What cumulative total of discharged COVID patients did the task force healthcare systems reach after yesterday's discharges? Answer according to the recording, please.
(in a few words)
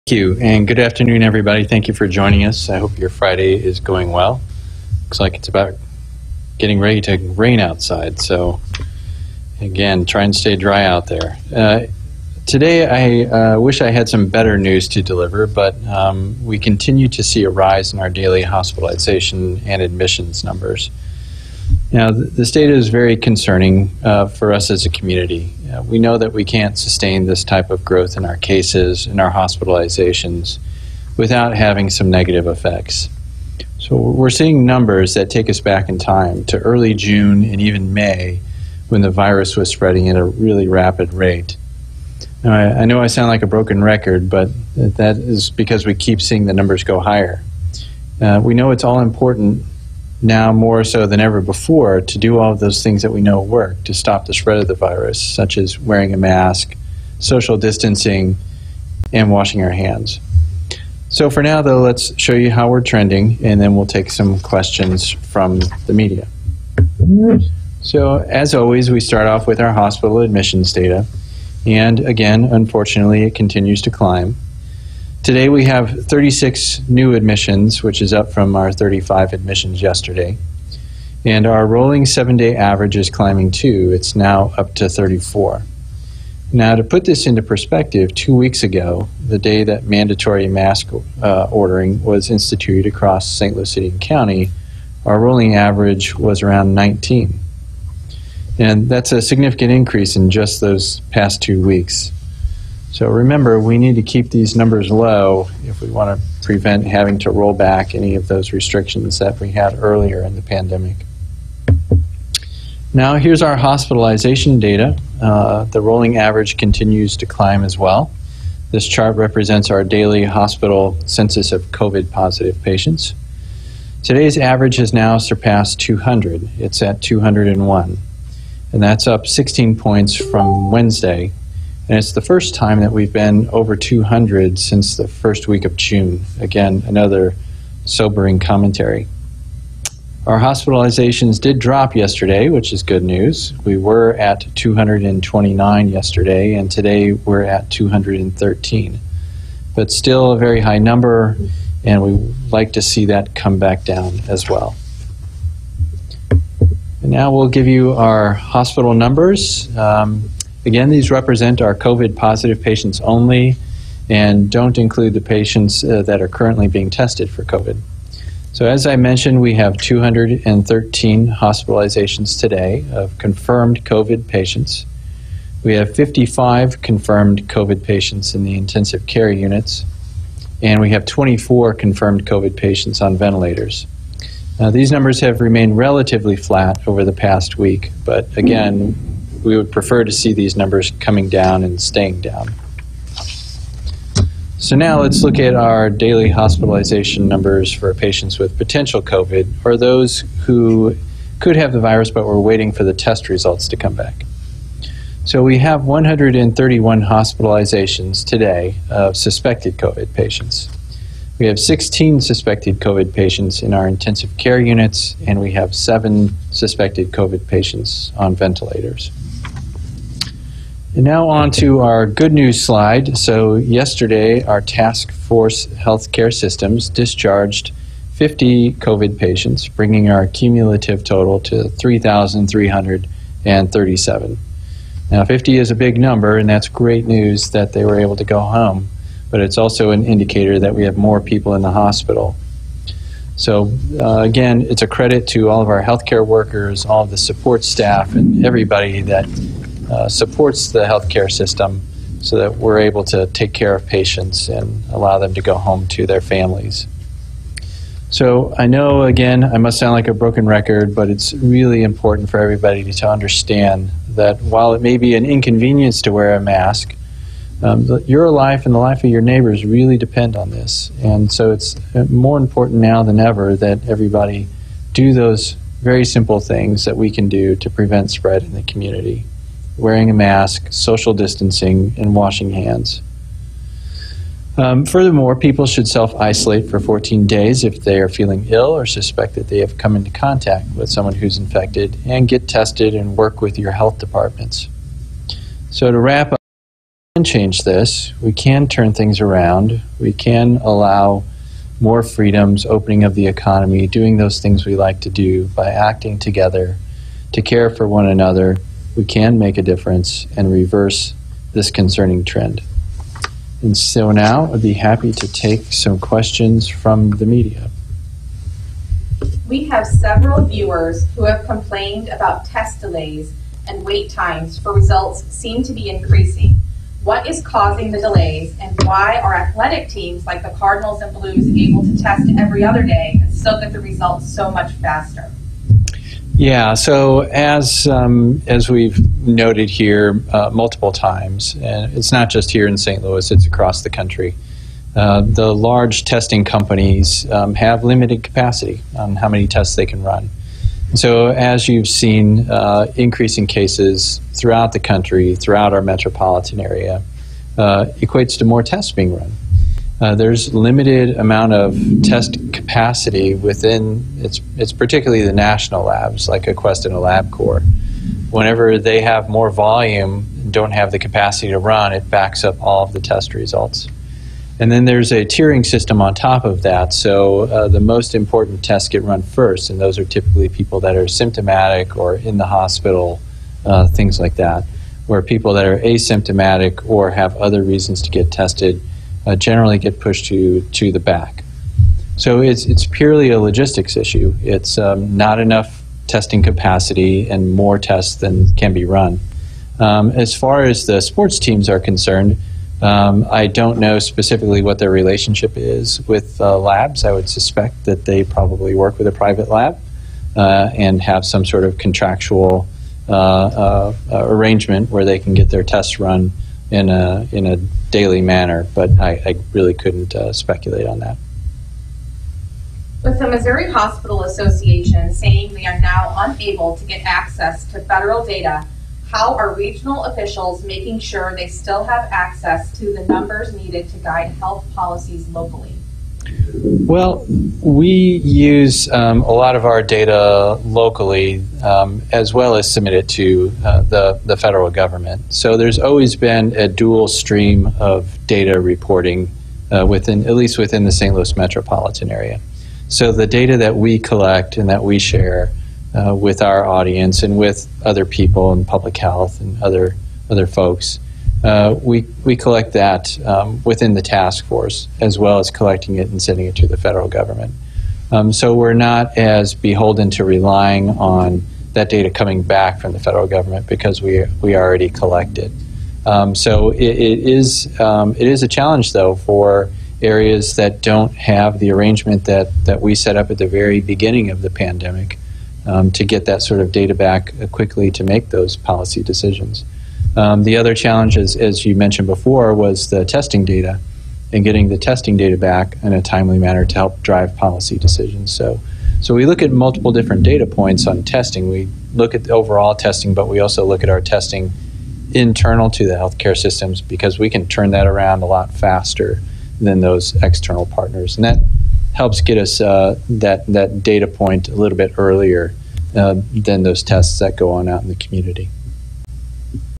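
3,337.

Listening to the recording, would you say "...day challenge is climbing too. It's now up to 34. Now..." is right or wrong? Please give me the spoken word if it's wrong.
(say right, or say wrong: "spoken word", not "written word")
wrong: "average", not "challenge".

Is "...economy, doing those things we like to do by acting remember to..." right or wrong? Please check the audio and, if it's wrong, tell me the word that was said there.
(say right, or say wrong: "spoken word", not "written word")
wrong: "together", not "remember".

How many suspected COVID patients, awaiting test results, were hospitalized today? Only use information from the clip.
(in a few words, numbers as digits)
131.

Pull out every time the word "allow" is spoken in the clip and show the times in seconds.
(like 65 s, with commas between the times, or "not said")
254 s, 300 s.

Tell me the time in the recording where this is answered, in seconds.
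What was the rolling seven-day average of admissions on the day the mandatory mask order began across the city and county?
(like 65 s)
96 s.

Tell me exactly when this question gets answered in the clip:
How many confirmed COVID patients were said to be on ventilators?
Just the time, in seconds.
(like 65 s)
181 s.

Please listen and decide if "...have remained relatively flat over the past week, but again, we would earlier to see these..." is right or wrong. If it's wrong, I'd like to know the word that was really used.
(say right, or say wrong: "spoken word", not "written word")
wrong: "prefer", not "earlier".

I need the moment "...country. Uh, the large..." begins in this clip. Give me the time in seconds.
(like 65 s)
343 s.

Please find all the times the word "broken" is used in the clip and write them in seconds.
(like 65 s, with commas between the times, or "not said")
43 s, 260 s.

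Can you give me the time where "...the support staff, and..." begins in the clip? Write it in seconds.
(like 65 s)
247 s.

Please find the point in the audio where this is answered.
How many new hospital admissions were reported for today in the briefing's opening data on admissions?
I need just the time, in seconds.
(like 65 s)
76 s.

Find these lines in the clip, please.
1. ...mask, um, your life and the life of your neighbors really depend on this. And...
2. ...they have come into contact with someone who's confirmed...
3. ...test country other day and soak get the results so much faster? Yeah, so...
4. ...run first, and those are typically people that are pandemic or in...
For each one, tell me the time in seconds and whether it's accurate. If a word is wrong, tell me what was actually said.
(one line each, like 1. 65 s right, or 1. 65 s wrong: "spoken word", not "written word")
1. 266 s right
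2. 289 s wrong: "infected", not "confirmed"
3. 331 s wrong: "every", not "country"
4. 379 s wrong: "symptomatic", not "pandemic".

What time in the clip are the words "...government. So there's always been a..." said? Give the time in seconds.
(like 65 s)
444 s.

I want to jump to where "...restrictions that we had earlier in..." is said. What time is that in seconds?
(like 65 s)
108 s.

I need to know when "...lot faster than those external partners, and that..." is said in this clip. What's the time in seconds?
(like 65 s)
508 s.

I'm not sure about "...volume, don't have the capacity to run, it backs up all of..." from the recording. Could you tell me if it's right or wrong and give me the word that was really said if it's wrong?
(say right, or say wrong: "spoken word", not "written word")
right.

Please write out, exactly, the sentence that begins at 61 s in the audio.
So for now, though, let's show you how we're trending, and then we'll take some questions from the media.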